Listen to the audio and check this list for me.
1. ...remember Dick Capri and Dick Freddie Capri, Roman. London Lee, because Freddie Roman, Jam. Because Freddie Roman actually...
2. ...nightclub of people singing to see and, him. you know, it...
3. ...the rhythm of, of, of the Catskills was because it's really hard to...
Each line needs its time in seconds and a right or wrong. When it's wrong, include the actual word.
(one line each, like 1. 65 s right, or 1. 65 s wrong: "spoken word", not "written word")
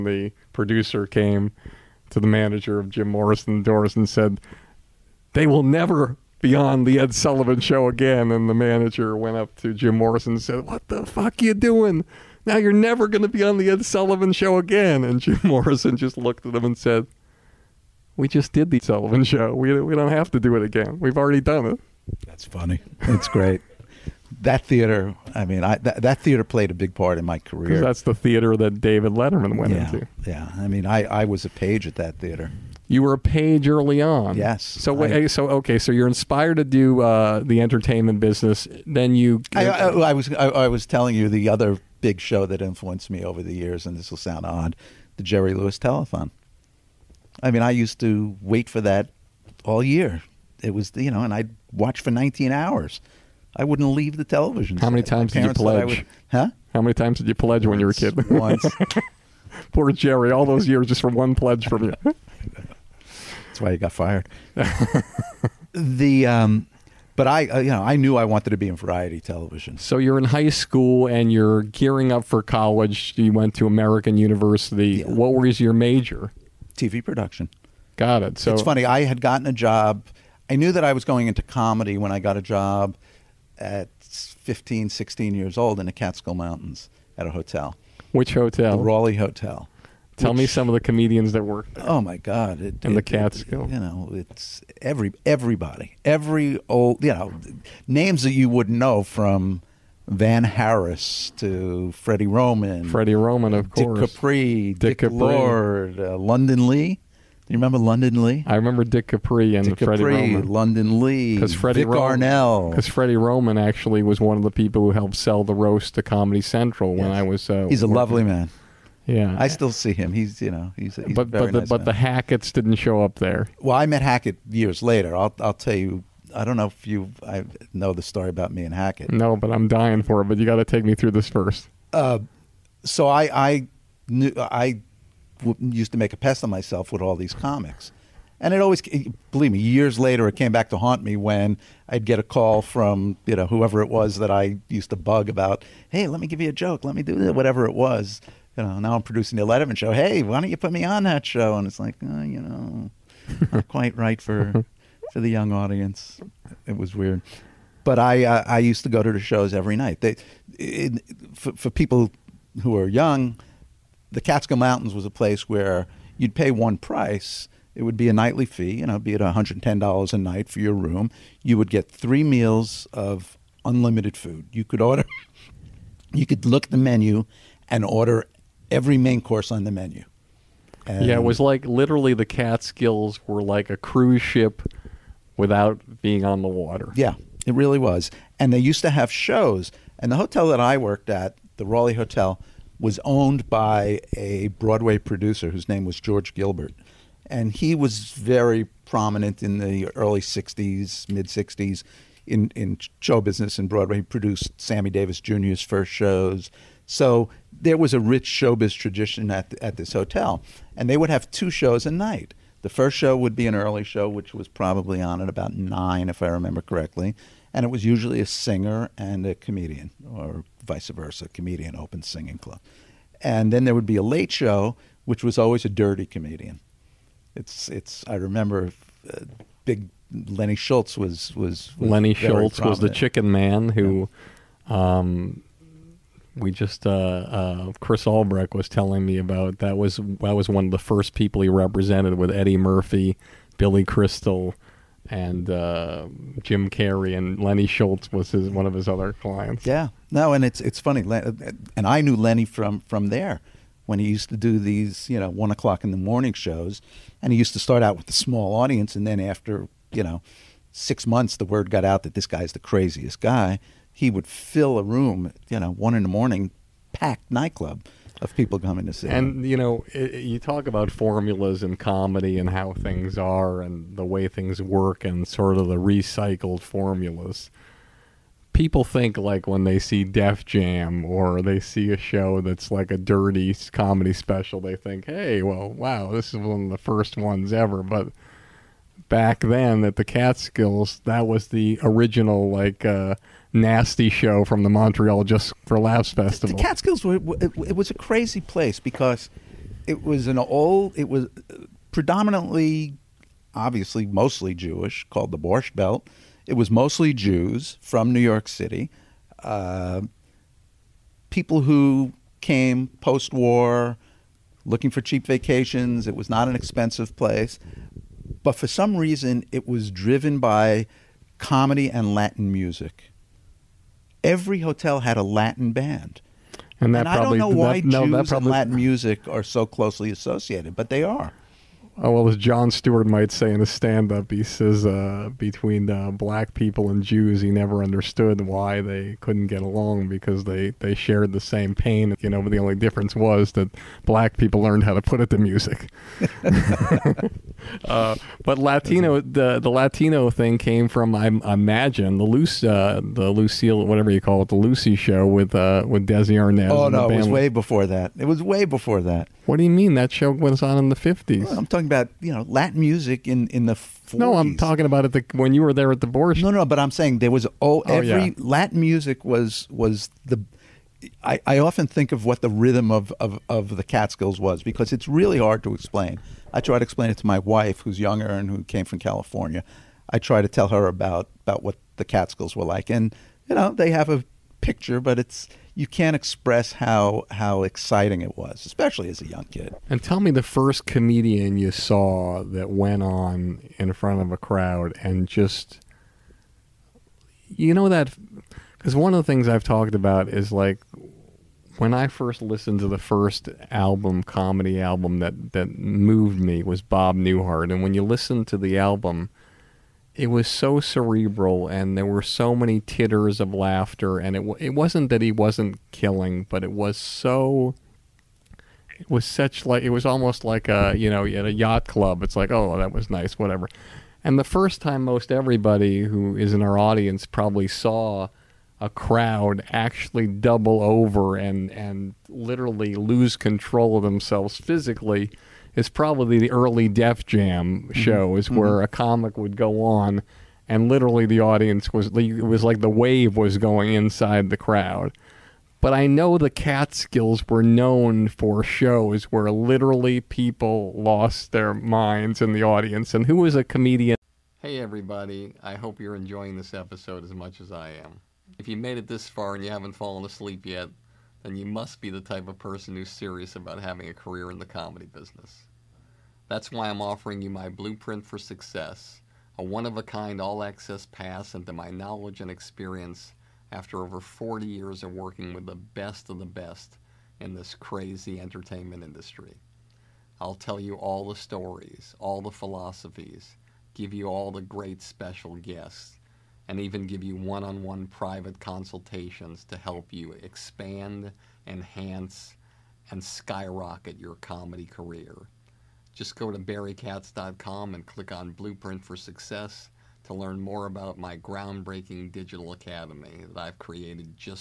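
1. 108 s wrong: "Arnell", not "Jam"
2. 267 s wrong: "coming", not "singing"
3. 372 s right.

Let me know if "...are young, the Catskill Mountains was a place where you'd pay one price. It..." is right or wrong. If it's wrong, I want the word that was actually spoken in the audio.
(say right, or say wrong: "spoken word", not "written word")
right.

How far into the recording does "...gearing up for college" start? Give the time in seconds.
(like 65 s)
71 s.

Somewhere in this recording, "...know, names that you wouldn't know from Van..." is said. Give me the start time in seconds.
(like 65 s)
97 s.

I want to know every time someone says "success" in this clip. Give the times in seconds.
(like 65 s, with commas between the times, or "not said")
468 s, 499 s.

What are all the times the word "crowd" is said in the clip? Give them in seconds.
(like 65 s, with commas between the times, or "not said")
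394 s, 428 s, 444 s.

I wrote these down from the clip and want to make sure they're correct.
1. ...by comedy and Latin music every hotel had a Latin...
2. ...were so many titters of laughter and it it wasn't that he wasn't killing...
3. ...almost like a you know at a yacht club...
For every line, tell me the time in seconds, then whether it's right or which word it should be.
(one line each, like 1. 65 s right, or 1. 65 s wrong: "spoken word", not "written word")
1. 320 s right
2. 412 s right
3. 420 s right.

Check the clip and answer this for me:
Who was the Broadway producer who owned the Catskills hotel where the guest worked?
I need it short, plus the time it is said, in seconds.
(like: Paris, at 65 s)
George Gilbert, at 195 s.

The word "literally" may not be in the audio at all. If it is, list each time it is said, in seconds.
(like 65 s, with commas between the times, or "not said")
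181 s, 432 s, 440 s, 449 s.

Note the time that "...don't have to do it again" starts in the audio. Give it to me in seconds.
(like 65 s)
19 s.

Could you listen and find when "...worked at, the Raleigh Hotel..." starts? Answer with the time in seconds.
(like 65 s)
190 s.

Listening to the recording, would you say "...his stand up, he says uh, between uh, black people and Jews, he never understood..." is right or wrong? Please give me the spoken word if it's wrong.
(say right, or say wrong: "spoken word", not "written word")
right.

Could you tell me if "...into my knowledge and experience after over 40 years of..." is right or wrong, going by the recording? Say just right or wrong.
right.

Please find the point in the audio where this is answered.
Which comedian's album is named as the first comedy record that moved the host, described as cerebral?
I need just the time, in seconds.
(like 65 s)
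406 s.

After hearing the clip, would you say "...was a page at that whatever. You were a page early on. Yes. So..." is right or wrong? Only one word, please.
wrong.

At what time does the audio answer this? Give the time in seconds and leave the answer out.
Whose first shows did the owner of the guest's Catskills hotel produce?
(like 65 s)
204 s.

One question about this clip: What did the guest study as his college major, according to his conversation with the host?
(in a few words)
TV production.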